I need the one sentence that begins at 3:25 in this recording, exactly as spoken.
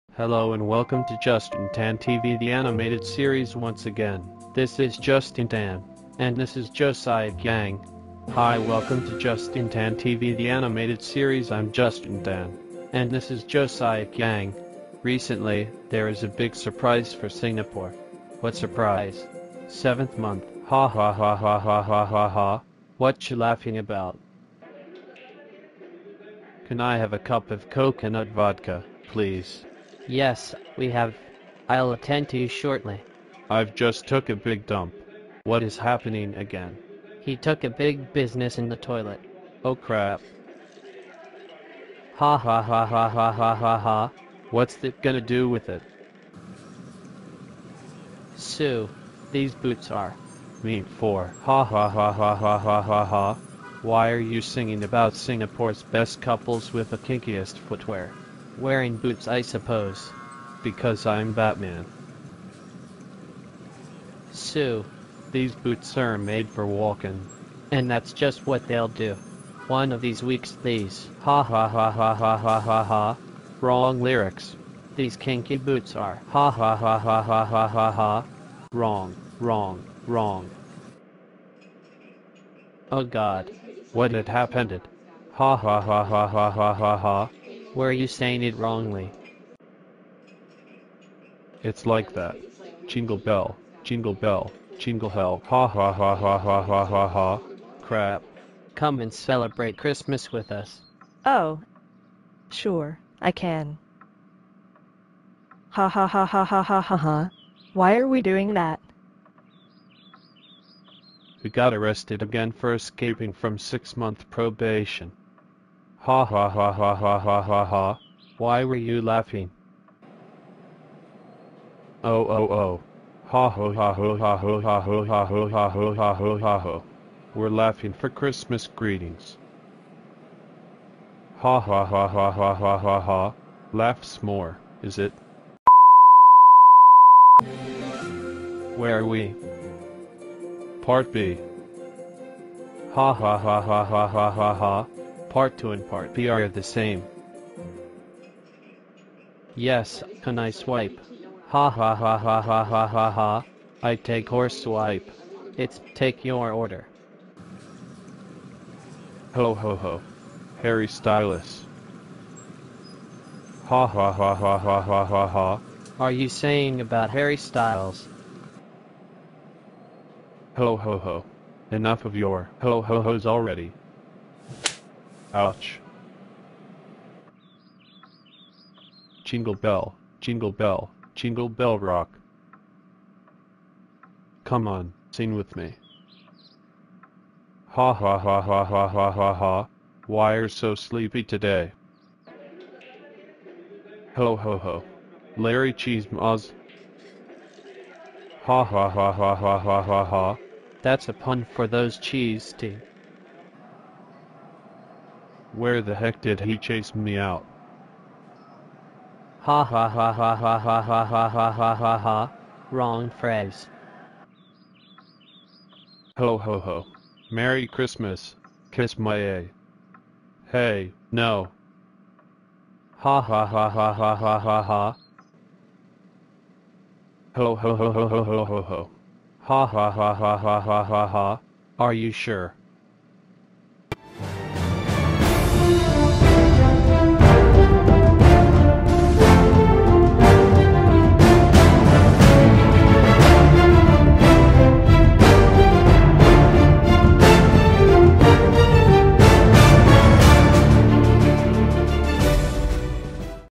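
Where the heck did he chase me out?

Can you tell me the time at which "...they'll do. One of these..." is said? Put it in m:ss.
1:08.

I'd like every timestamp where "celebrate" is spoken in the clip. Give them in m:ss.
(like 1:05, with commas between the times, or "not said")
1:39.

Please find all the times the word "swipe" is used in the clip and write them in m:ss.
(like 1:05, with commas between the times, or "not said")
2:30, 2:34.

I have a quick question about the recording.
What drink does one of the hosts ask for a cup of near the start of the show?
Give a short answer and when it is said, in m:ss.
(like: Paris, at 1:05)
Coconut vodka, at 0:27.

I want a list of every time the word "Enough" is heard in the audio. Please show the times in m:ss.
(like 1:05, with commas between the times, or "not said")
2:51.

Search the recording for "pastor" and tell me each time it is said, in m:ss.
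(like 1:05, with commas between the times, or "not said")
not said.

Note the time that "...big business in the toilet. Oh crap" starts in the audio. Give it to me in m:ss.
0:37.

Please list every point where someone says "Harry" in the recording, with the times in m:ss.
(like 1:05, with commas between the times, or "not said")
2:40, 2:47.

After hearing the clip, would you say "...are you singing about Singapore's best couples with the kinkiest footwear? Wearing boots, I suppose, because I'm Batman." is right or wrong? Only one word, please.
right.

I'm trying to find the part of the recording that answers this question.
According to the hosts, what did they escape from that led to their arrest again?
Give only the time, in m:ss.
1:53.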